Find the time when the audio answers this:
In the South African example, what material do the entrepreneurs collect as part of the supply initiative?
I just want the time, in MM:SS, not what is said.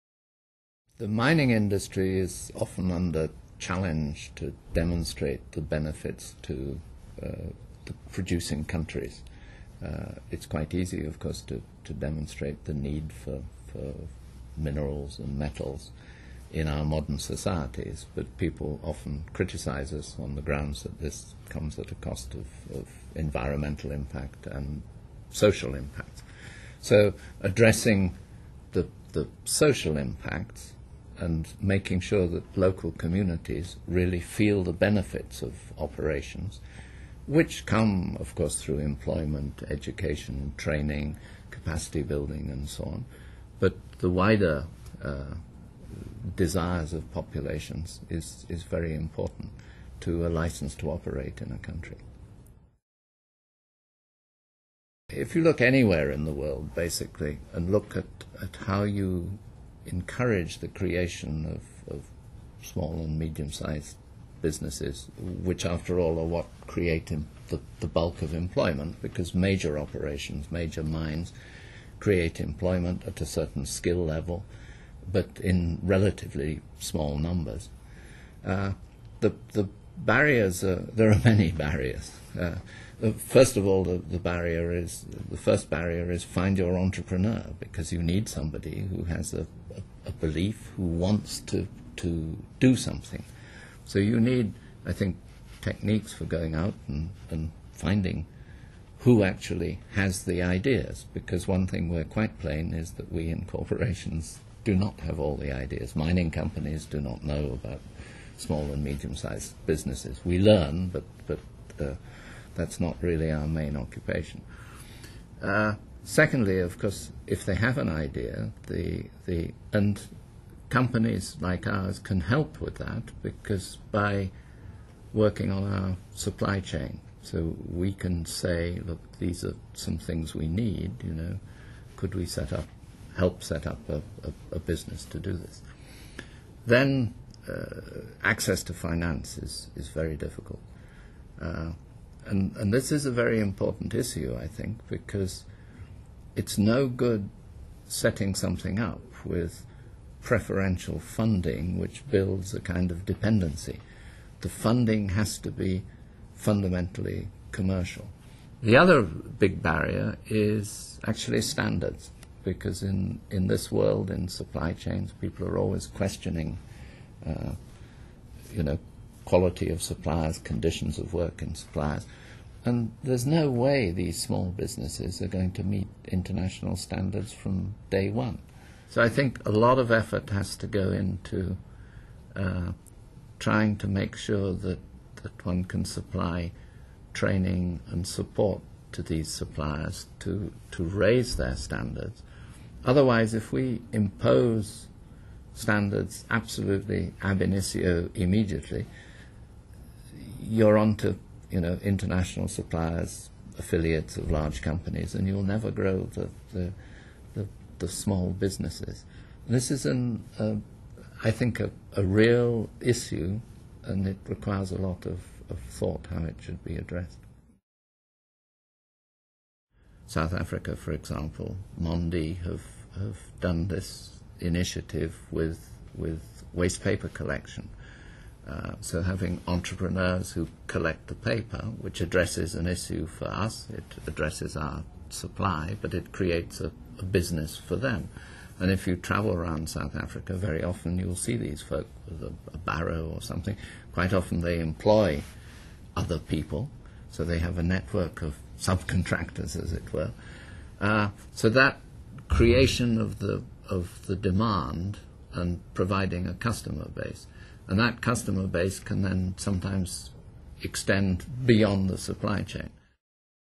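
03:46.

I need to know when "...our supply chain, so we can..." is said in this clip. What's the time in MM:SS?
02:05.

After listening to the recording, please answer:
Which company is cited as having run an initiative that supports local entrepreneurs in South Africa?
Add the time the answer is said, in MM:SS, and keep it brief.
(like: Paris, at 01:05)
Mondi, at 03:41.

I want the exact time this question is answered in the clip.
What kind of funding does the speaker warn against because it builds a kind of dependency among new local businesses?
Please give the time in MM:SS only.
02:30.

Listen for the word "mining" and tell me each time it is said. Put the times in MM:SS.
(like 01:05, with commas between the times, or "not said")
00:01, 01:45.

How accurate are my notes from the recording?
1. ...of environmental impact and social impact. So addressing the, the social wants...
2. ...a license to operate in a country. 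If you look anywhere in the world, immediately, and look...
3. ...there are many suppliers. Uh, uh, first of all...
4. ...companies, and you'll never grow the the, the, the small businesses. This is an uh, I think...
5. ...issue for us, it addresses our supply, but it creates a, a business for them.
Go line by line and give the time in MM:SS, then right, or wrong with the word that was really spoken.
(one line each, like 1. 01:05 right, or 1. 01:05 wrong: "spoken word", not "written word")
1. 00:22 wrong: "impacts", not "wants"
2. 00:50 wrong: "basically", not "immediately"
3. 01:20 wrong: "barriers", not "suppliers"
4. 03:24 right
5. 03:52 right.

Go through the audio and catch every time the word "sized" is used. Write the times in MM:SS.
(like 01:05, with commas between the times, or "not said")
01:03, 01:48.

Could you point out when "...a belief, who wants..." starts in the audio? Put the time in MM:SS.
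01:30.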